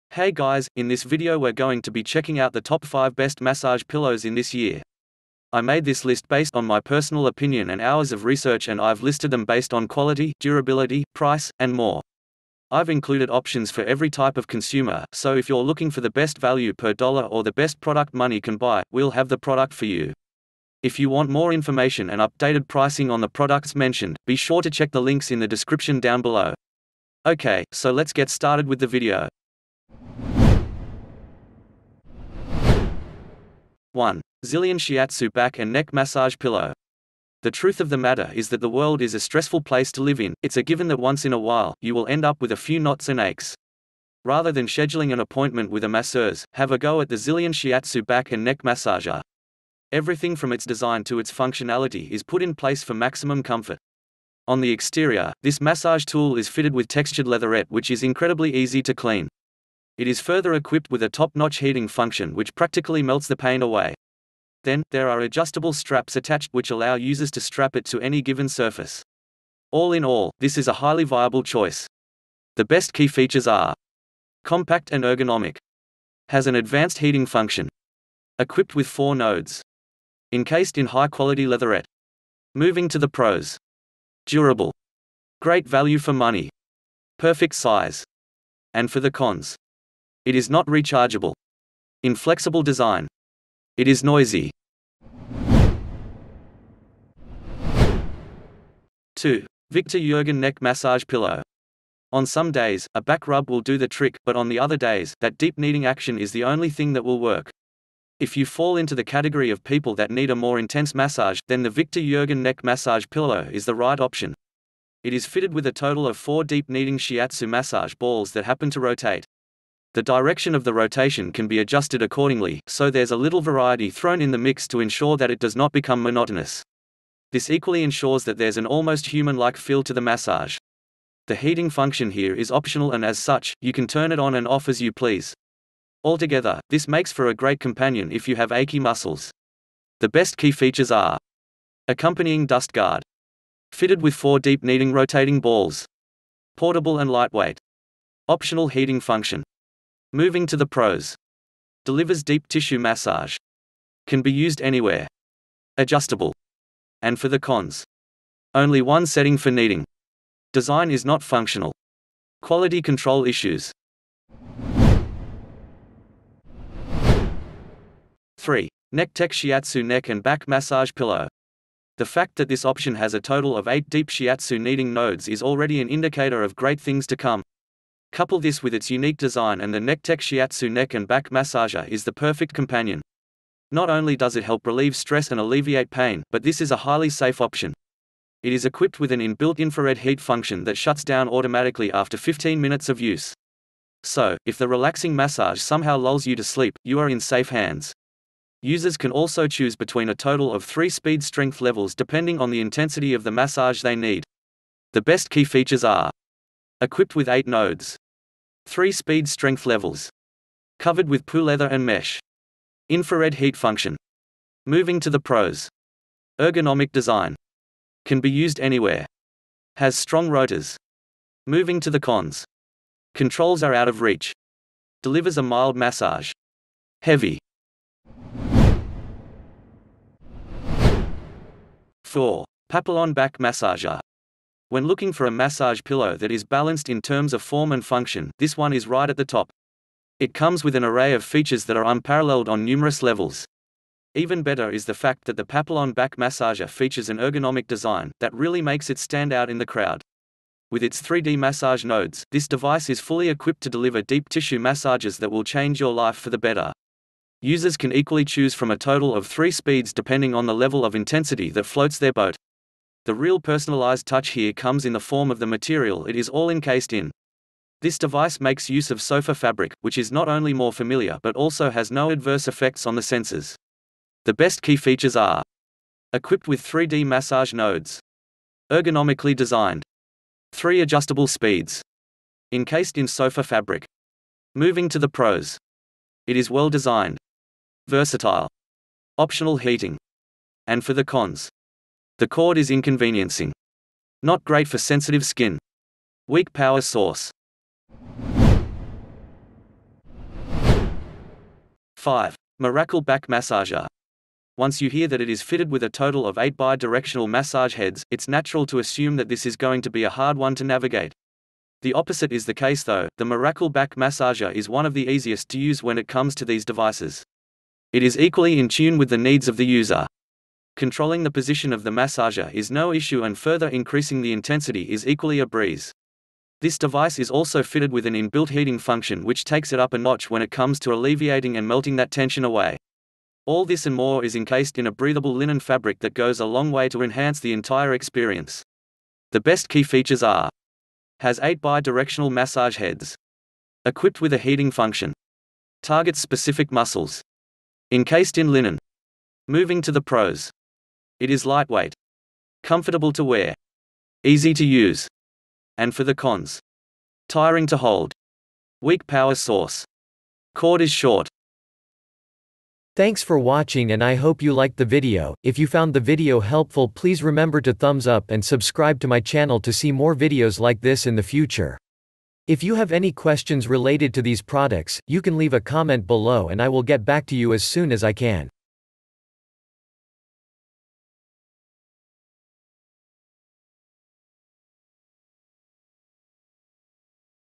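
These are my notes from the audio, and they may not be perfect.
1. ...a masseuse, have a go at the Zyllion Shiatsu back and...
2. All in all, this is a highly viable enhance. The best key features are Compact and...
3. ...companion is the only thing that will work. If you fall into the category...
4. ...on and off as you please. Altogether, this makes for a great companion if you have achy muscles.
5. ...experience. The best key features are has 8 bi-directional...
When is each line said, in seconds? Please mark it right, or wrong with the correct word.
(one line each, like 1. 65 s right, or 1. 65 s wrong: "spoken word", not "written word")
1. 45 s right
2. 69 s wrong: "choice", not "enhance"
3. 105 s wrong: "action", not "companion"
4. 134 s right
5. 337 s right.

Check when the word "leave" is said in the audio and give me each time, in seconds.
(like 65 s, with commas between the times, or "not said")
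375 s.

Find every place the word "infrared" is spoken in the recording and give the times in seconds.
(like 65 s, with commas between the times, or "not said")
189 s, 212 s.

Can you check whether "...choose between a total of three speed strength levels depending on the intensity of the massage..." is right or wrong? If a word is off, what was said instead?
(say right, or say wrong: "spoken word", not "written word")
right.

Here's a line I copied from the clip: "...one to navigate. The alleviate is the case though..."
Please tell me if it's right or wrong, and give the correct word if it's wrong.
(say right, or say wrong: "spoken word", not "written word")
wrong: "opposite", not "alleviate".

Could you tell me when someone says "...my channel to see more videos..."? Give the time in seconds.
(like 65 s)
369 s.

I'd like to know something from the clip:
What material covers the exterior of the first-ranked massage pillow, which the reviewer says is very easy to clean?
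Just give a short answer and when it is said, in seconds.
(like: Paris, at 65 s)
textured leatherette, at 56 s.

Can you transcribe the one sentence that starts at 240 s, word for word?
It comes with an array of features that are unparalleled on numerous levels.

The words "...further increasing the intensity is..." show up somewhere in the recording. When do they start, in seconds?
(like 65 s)
323 s.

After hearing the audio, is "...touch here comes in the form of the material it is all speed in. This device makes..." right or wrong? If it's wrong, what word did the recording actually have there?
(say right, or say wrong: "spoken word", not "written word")
wrong: "encased", not "speed".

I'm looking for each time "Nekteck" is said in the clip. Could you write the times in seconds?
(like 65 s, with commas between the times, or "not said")
168 s, 179 s.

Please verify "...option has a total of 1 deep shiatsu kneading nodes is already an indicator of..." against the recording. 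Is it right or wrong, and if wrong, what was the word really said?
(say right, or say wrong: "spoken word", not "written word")
wrong: "8", not "1".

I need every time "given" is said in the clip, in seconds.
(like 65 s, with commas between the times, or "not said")
40 s, 68 s.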